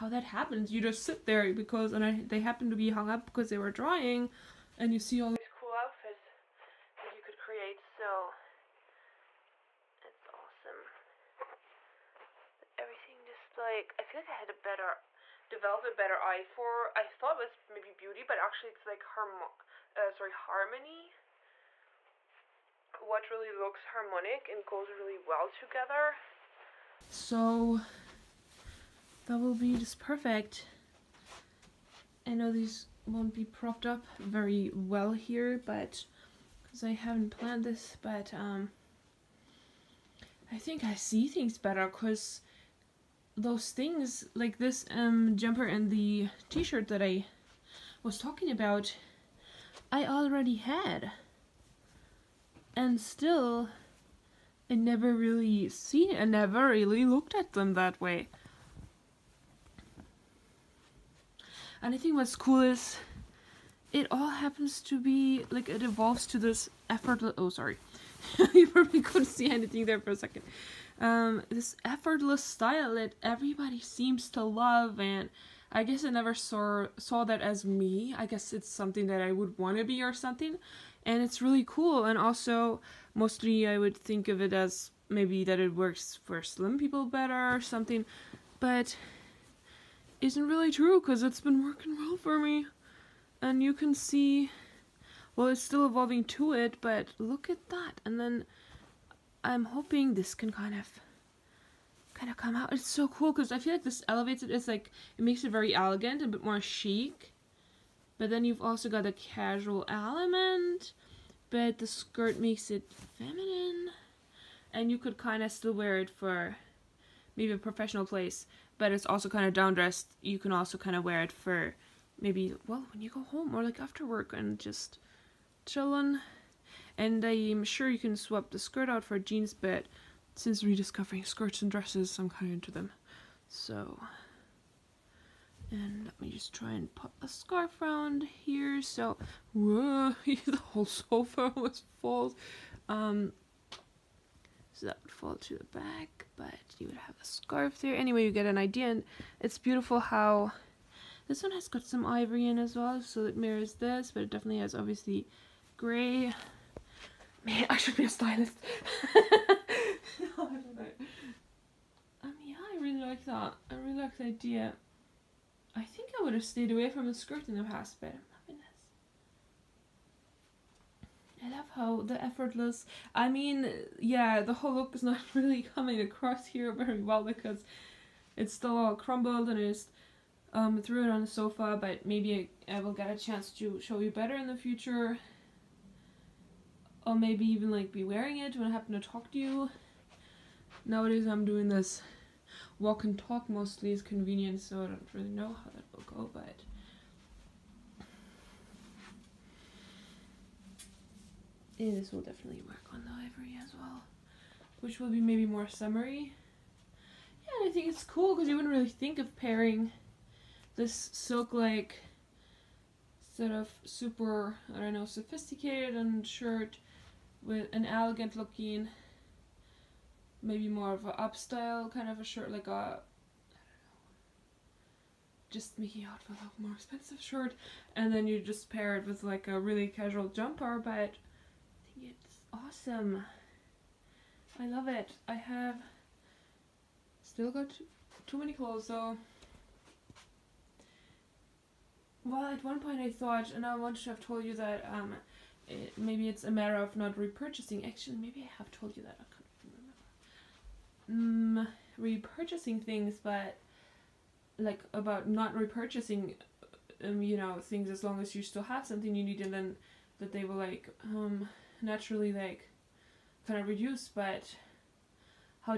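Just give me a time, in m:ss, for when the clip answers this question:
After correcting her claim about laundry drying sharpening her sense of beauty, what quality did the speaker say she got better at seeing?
0:20.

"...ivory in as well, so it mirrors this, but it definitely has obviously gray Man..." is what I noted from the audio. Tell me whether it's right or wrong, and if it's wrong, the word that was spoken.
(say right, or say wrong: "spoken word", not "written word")
right.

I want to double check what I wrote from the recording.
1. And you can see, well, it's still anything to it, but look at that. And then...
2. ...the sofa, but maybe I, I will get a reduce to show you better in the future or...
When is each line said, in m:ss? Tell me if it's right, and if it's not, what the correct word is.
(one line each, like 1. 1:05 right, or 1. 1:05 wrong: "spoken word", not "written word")
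1. 1:33 wrong: "evolving", not "anything"
2. 3:01 wrong: "chance", not "reduce".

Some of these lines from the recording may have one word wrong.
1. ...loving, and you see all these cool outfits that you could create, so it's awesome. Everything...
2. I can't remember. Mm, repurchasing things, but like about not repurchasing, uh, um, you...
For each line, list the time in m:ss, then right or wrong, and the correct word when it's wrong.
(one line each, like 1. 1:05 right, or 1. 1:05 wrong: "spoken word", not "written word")
1. 0:03 wrong: "drying", not "loving"
2. 4:09 right.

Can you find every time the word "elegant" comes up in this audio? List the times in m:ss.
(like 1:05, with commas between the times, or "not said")
1:45, 3:37.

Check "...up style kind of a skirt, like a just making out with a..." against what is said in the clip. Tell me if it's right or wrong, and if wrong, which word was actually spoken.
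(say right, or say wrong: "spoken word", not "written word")
wrong: "shirt", not "skirt".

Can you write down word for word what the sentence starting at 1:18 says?
I guess it's something that I would want to be or something.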